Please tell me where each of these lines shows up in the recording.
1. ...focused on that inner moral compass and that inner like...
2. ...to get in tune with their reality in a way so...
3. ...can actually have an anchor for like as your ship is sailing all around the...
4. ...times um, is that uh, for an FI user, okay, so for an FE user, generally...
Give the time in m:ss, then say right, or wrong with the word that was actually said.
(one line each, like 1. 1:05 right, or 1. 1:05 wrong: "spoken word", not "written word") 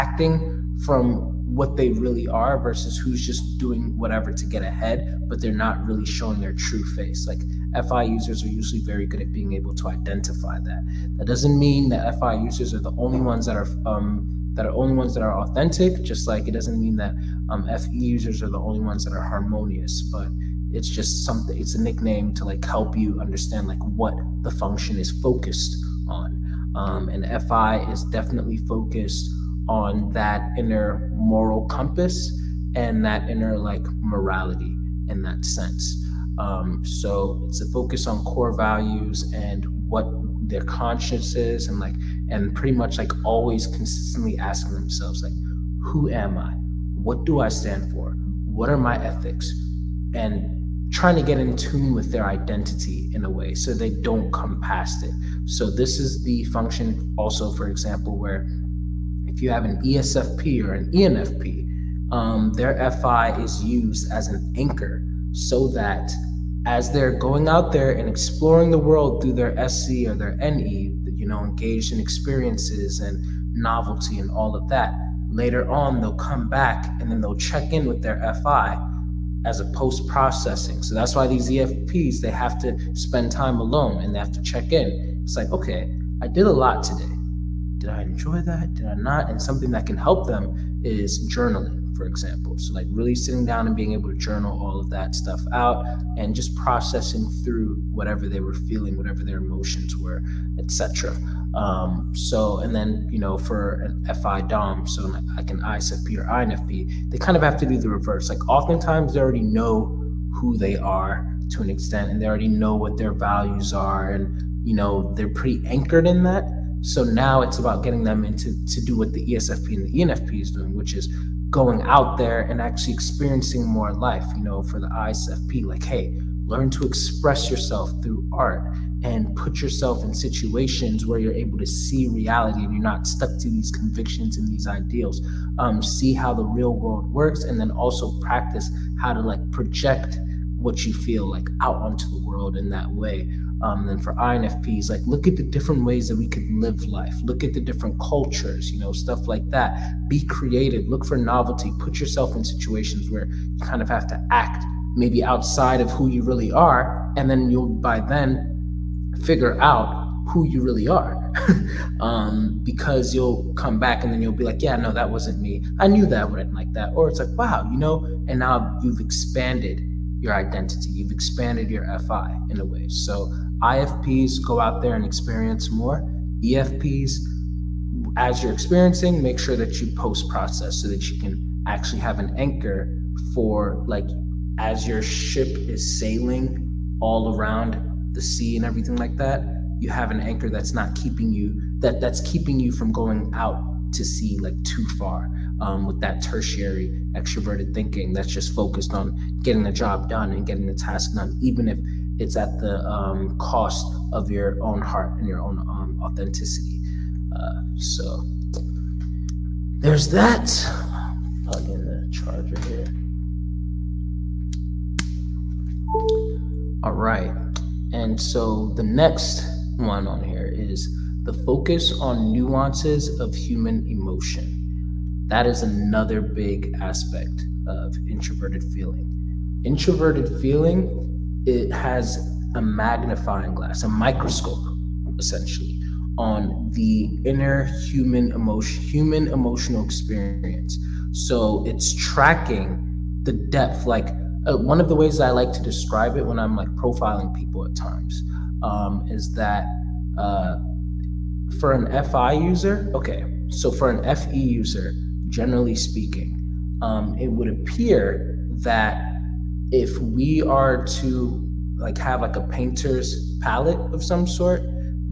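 1. 0:28 right
2. 0:51 wrong: "identity", not "reality"
3. 3:01 right
4. 4:07 right.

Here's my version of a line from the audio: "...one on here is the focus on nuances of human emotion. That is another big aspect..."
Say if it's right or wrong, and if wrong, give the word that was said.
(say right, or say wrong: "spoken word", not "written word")
right.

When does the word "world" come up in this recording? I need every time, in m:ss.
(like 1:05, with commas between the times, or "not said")
1:08, 2:16, 2:22.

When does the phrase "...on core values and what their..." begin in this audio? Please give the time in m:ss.
0:38.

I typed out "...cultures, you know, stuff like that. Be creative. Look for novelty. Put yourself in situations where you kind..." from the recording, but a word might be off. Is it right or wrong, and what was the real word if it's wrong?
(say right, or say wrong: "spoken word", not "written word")
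right.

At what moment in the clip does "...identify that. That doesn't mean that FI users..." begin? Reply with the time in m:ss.
0:09.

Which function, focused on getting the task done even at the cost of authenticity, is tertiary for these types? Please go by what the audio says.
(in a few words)
Extroverted thinking.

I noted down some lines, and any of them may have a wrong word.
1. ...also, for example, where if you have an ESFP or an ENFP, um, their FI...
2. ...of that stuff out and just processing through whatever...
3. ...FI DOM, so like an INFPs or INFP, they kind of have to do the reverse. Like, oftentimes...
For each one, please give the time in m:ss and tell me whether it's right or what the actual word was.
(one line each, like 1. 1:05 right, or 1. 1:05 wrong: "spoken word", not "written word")
1. 0:57 right
2. 1:34 right
3. 1:44 wrong: "ISFP", not "INFPs".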